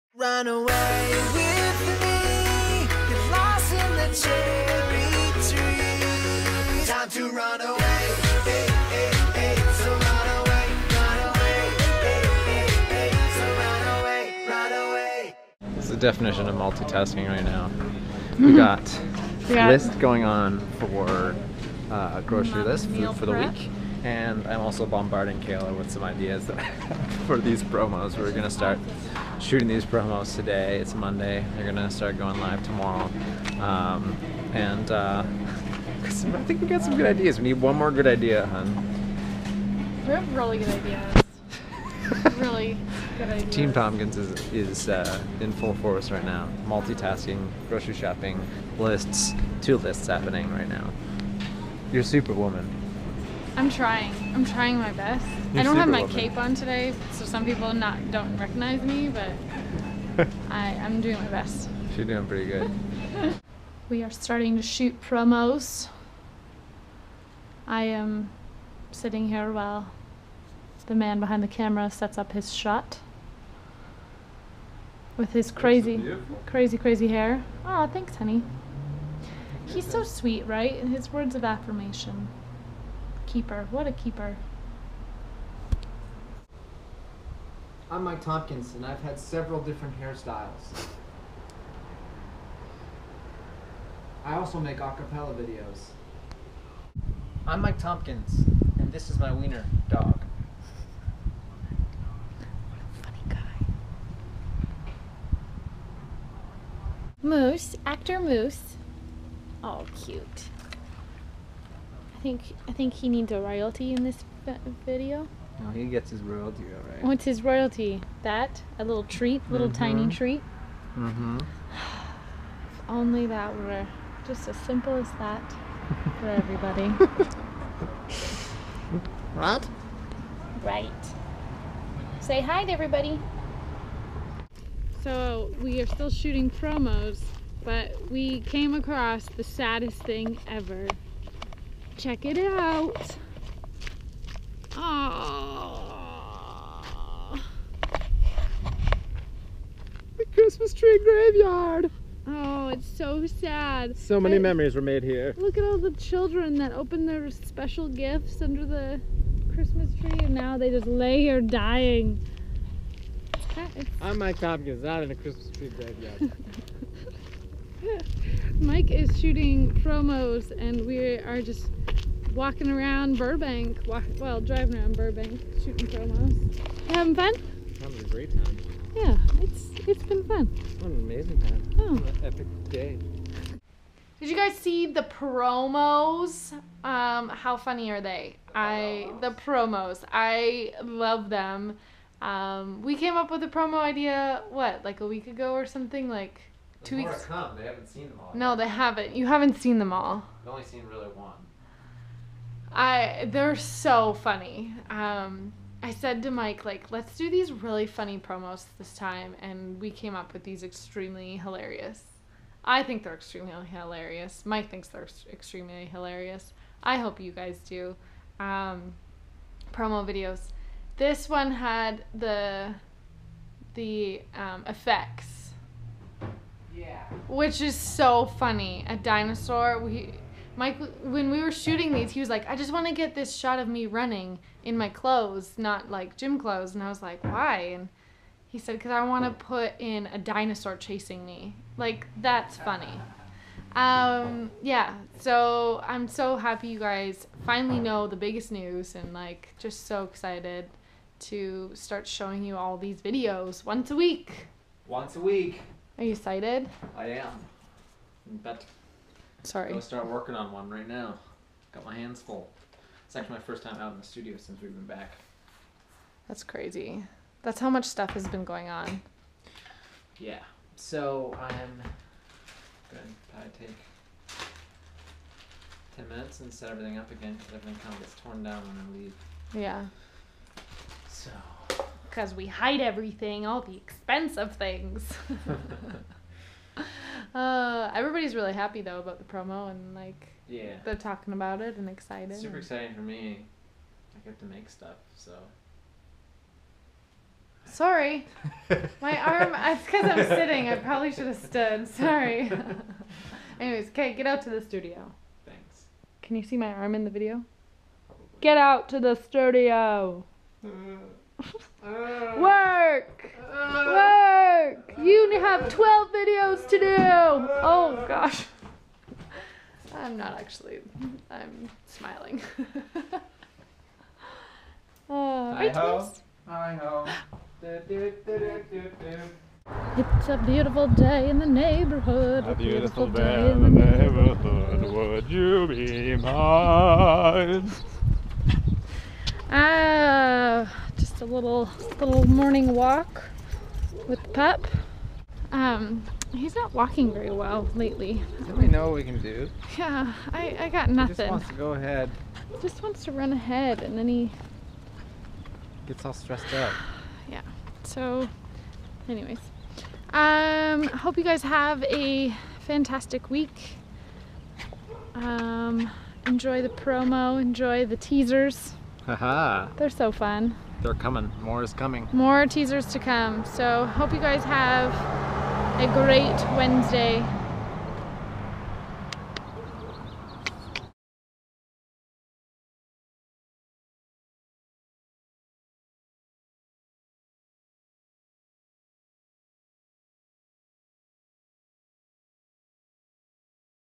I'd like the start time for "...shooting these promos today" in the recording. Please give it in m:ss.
0:29.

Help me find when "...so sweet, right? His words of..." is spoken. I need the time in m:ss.
1:19.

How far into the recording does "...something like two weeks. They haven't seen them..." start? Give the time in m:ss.
3:15.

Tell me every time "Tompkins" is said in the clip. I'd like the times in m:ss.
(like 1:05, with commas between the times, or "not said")
0:43, 1:28, 1:37, 2:44.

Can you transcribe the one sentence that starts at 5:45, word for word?
Um, he's not walking very well lately.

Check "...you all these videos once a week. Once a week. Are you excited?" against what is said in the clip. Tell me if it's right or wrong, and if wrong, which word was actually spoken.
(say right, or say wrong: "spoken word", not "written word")
right.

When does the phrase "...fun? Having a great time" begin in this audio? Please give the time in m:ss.
2:57.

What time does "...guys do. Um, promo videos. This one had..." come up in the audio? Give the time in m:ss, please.
3:37.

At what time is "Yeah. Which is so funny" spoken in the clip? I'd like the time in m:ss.
3:46.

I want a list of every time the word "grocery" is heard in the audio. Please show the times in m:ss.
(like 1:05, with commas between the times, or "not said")
0:22, 0:47.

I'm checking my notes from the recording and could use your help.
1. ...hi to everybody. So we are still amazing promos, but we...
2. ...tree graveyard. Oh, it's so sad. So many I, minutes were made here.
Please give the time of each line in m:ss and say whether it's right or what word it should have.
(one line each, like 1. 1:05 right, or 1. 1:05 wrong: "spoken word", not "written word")
1. 2:12 wrong: "shooting", not "amazing"
2. 2:30 wrong: "memories", not "minutes".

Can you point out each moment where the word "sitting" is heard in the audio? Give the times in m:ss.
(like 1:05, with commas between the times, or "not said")
1:08, 5:00.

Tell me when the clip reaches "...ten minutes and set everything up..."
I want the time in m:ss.
4:35.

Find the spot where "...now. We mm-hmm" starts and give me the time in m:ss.
0:17.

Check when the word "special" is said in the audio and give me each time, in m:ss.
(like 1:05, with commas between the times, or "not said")
2:37.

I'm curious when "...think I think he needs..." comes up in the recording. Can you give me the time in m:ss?
1:52.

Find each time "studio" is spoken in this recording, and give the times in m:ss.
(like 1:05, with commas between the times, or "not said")
4:24, 5:04, 5:09.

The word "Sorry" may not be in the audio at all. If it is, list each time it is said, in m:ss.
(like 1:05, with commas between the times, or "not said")
4:19, 4:57, 5:01.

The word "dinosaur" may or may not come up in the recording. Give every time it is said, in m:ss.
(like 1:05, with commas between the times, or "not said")
3:48, 4:00.